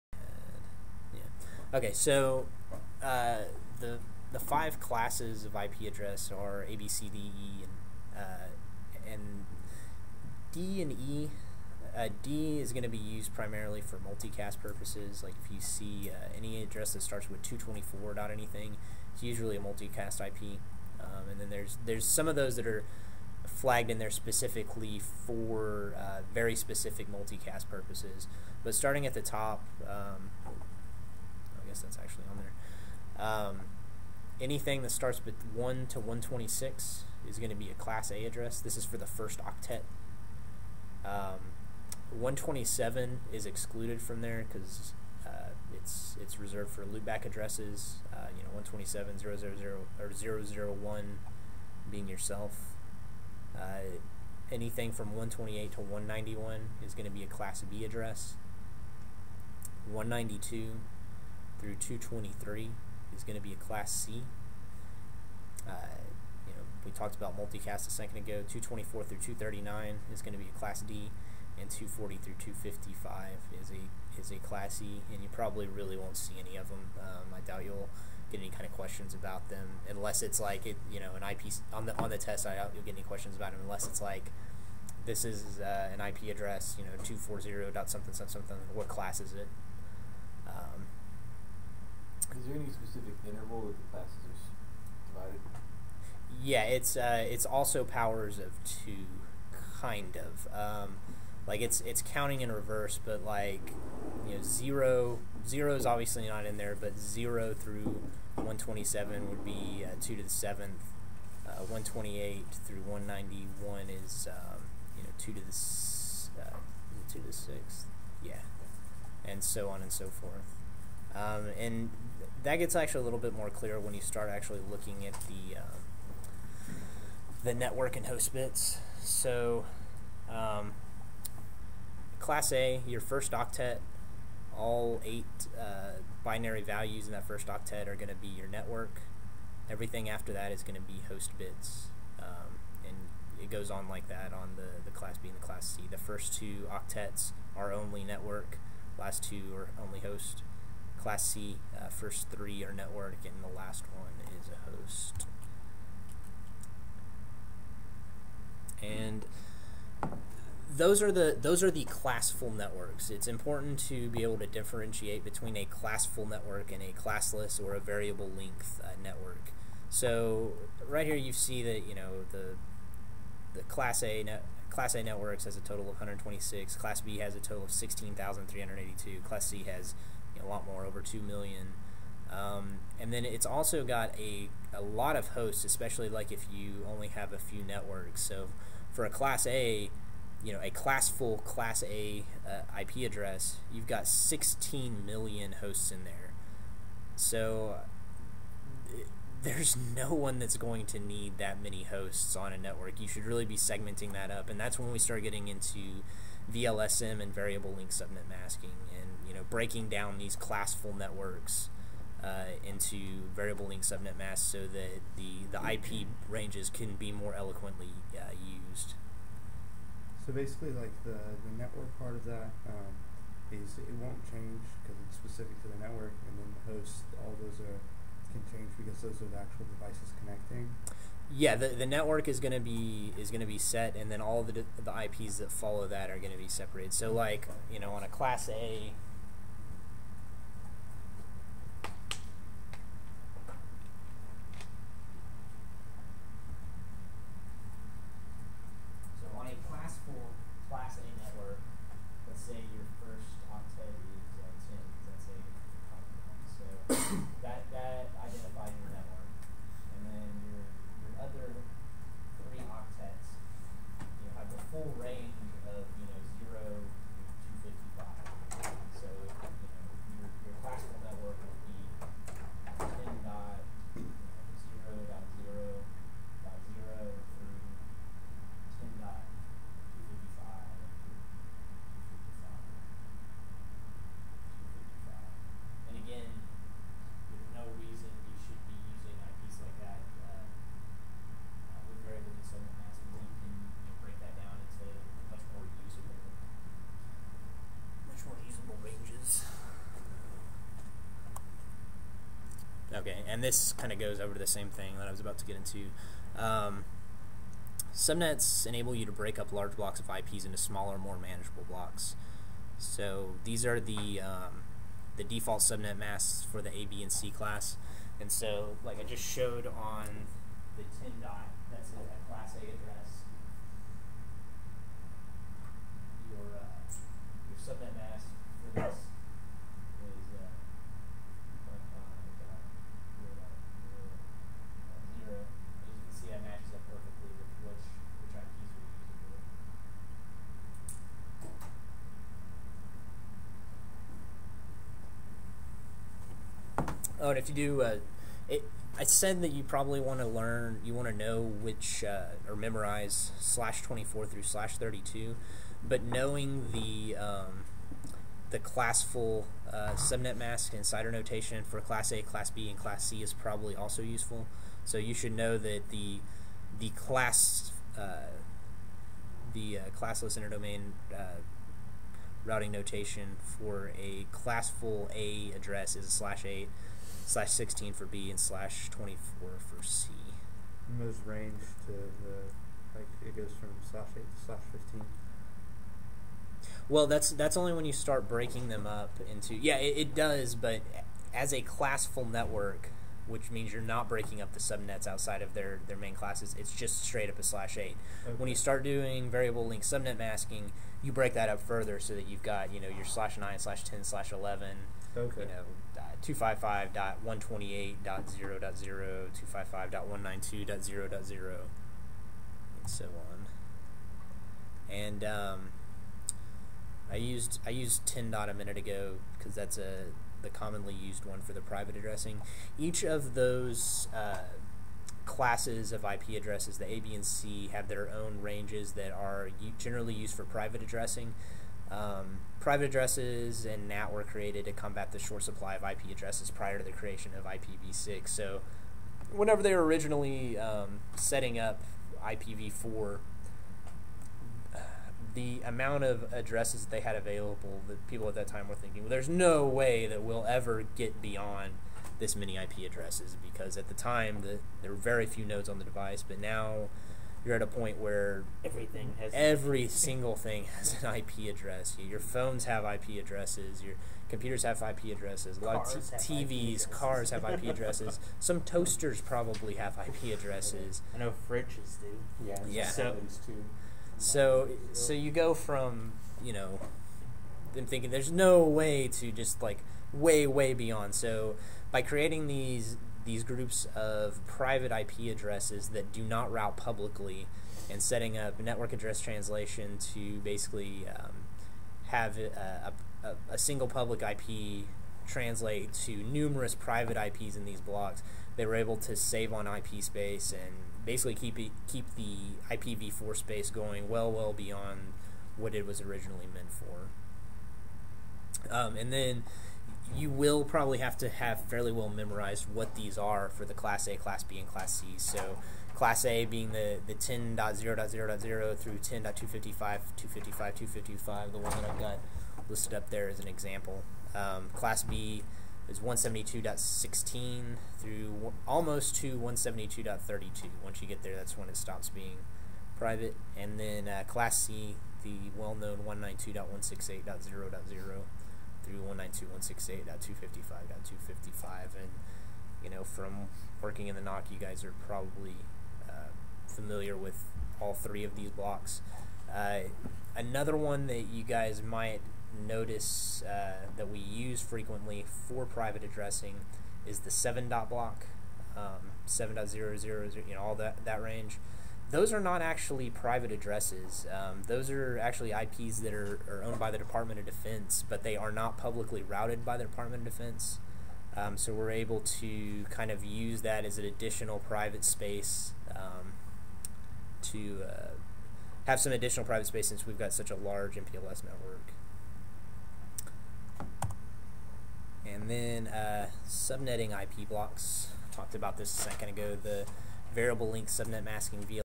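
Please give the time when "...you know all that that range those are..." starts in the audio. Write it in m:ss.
9:20.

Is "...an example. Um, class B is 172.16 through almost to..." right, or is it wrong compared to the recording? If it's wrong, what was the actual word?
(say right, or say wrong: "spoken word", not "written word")
right.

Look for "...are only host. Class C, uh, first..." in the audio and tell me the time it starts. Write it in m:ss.
2:29.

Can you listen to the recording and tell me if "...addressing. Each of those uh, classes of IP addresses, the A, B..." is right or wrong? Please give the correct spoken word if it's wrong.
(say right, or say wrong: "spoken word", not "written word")
right.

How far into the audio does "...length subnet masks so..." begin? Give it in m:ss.
3:33.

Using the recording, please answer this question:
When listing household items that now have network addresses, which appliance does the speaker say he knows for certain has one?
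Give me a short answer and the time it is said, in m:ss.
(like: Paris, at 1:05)
Fridges, at 7:51.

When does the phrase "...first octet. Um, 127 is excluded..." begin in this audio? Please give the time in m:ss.
0:39.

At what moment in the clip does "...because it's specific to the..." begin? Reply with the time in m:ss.
3:44.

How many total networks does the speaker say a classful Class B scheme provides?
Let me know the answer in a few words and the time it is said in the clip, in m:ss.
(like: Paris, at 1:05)
16,382, at 2:57.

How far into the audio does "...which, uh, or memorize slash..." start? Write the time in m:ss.
5:51.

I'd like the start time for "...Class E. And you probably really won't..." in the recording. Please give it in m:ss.
1:14.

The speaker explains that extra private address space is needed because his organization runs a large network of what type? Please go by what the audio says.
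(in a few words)
MPLS.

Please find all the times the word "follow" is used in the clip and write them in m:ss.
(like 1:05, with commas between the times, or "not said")
3:55.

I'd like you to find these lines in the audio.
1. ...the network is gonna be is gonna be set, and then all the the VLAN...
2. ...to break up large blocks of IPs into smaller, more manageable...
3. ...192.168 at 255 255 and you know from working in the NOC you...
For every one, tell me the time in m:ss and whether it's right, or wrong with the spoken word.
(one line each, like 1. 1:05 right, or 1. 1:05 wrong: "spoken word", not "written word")
1. 3:51 wrong: "IPs", not "VLAN"
2. 5:09 right
3. 8:58 right.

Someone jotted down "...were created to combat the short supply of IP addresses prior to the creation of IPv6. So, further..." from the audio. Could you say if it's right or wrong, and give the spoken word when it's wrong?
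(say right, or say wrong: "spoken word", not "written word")
wrong: "whenever", not "further".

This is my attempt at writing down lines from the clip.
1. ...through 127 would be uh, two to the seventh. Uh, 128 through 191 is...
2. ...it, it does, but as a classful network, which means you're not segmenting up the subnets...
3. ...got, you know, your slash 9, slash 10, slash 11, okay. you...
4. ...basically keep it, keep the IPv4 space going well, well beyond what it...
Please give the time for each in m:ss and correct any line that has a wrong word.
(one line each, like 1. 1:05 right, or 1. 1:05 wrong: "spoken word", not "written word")
1. 1:47 right
2. 6:29 wrong: "breaking", not "segmenting"
3. 6:42 right
4. 8:21 right.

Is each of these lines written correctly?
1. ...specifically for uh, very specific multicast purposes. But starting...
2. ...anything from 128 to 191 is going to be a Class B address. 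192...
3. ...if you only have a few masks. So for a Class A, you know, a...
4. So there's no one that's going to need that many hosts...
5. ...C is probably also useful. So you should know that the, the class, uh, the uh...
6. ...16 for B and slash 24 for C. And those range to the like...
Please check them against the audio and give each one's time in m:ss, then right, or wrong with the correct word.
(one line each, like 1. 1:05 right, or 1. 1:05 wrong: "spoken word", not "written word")
1. 0:24 right
2. 0:54 right
3. 3:06 wrong: "networks", not "masks"
4. 3:17 right
5. 6:03 right
6. 6:17 right.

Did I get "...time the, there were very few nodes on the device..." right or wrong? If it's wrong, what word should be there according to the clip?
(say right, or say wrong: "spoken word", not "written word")
right.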